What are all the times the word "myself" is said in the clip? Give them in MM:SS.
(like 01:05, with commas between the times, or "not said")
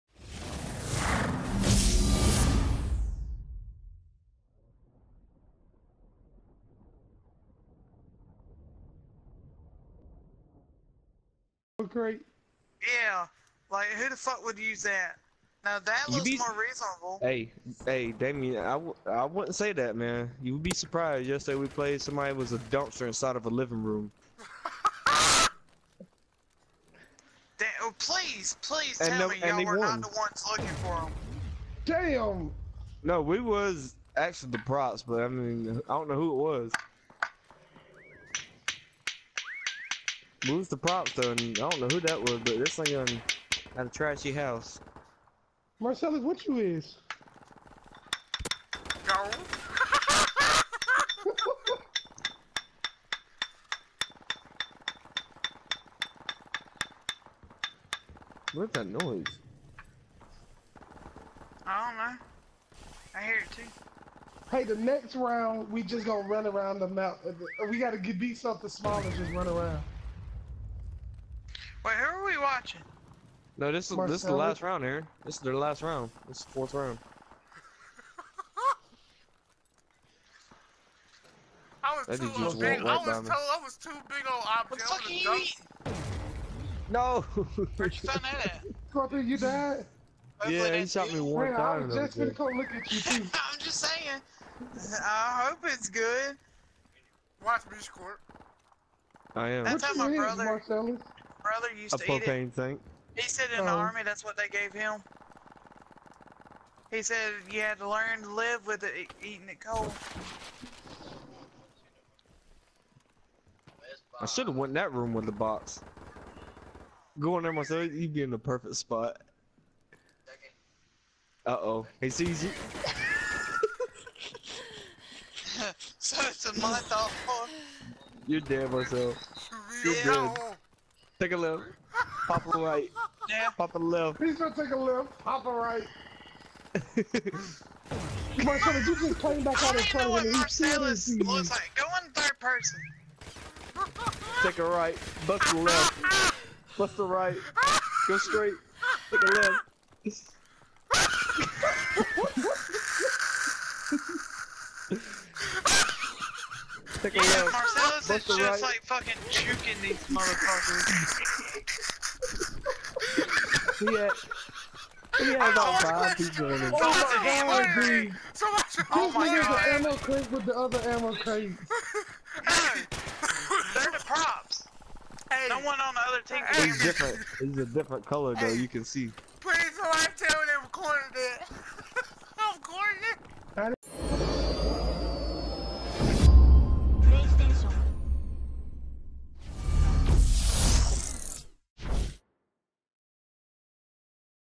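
01:57, 02:08.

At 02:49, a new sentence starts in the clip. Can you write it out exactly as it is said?
This ammo crate with the other ammo crate.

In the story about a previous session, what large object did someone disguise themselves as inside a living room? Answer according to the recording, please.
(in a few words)
A dumpster.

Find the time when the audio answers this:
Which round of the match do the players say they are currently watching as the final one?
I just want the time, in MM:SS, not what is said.
01:16.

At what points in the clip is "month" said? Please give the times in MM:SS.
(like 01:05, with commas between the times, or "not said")
02:06.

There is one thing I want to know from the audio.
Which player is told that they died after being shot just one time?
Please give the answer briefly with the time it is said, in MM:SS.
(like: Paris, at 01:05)
Scorpio, at 01:28.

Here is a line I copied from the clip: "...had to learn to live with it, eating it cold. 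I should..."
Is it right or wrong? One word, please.
right.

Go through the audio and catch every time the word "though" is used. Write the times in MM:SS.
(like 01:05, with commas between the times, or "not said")
00:41, 02:58.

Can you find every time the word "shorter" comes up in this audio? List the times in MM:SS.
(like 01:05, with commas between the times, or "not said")
not said.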